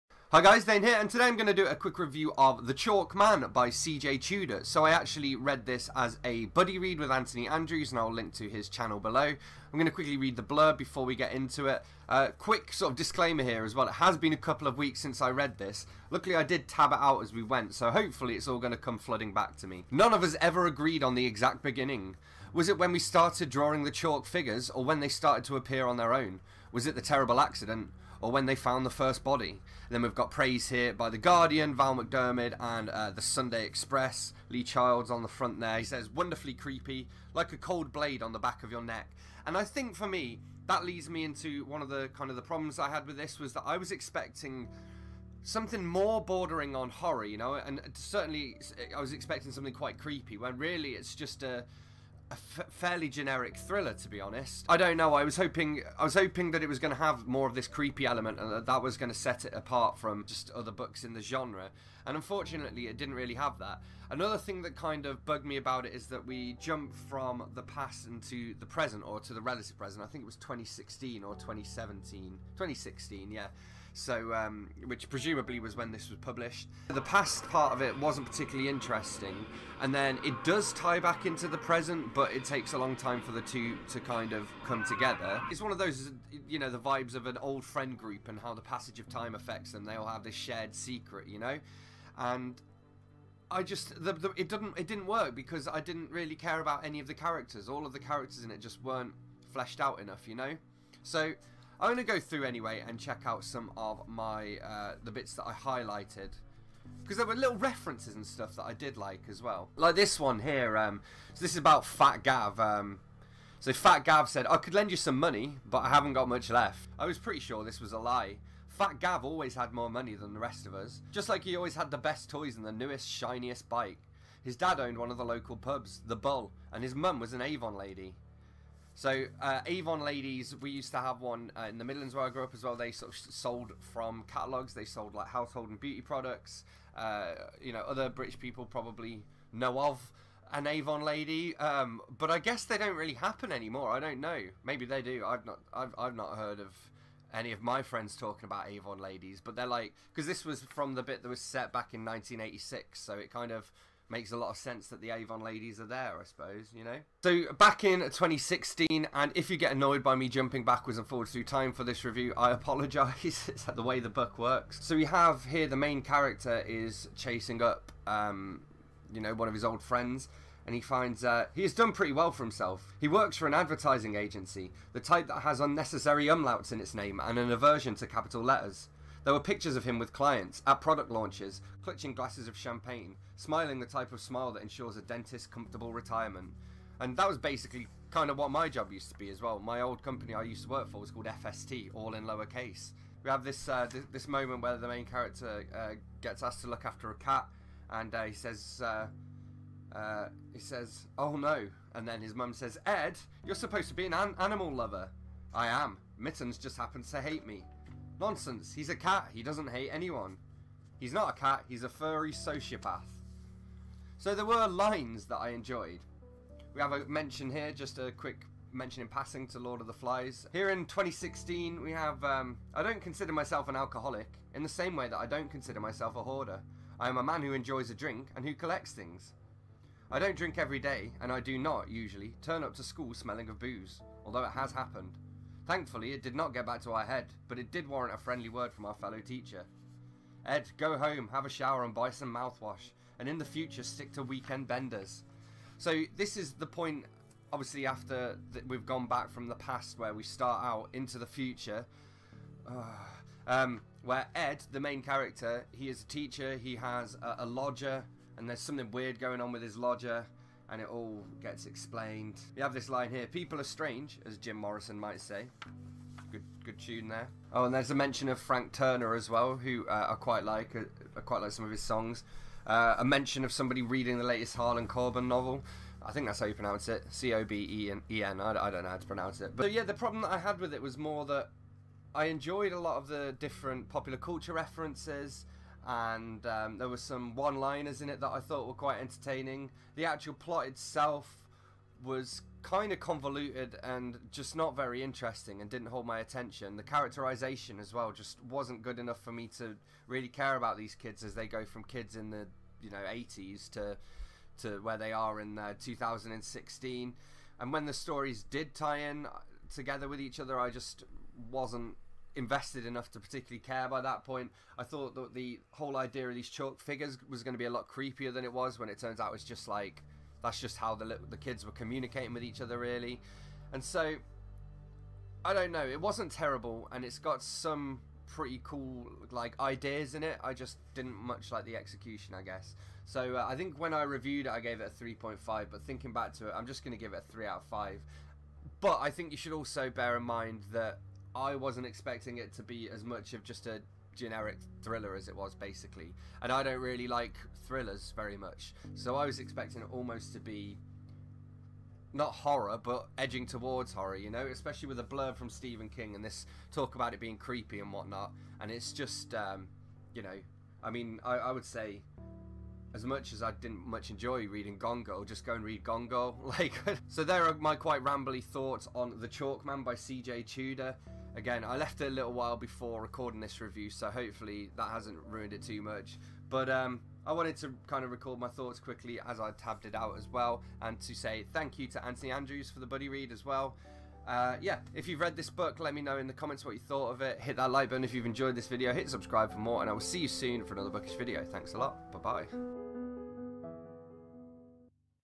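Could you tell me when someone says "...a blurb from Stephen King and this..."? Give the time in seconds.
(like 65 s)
354 s.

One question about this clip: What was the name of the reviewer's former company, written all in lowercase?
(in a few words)
FST.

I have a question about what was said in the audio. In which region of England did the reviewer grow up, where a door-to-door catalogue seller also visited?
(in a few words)
the Midlands.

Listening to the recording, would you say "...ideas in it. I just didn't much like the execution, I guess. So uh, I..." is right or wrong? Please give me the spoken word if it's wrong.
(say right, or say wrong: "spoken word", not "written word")
right.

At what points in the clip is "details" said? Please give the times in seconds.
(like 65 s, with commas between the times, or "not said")
not said.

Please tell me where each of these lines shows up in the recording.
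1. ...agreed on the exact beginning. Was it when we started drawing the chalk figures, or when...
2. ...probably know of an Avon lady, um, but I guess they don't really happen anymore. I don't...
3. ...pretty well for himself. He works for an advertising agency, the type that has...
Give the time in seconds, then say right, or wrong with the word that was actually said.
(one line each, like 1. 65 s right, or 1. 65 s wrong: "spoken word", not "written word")
1. 20 s right
2. 138 s right
3. 171 s right.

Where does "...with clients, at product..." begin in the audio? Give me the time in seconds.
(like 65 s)
179 s.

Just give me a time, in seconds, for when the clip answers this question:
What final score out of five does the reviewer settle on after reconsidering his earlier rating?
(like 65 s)
337 s.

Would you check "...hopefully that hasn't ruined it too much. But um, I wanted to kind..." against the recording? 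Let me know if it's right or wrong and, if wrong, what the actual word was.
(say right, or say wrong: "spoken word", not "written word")
right.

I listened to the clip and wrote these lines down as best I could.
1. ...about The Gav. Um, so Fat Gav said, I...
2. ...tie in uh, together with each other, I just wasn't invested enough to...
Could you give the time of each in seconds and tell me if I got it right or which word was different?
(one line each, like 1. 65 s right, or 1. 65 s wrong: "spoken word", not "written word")
1. 111 s wrong: "Fat", not "The"
2. 308 s right.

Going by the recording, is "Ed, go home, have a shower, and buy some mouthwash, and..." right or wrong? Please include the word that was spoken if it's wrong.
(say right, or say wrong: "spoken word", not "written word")
right.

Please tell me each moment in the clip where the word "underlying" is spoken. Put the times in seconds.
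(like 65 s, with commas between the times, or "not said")
not said.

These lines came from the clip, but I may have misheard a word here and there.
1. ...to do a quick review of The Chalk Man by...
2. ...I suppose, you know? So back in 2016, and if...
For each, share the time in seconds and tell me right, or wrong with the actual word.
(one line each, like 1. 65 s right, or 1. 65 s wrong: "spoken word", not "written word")
1. 1 s right
2. 156 s right.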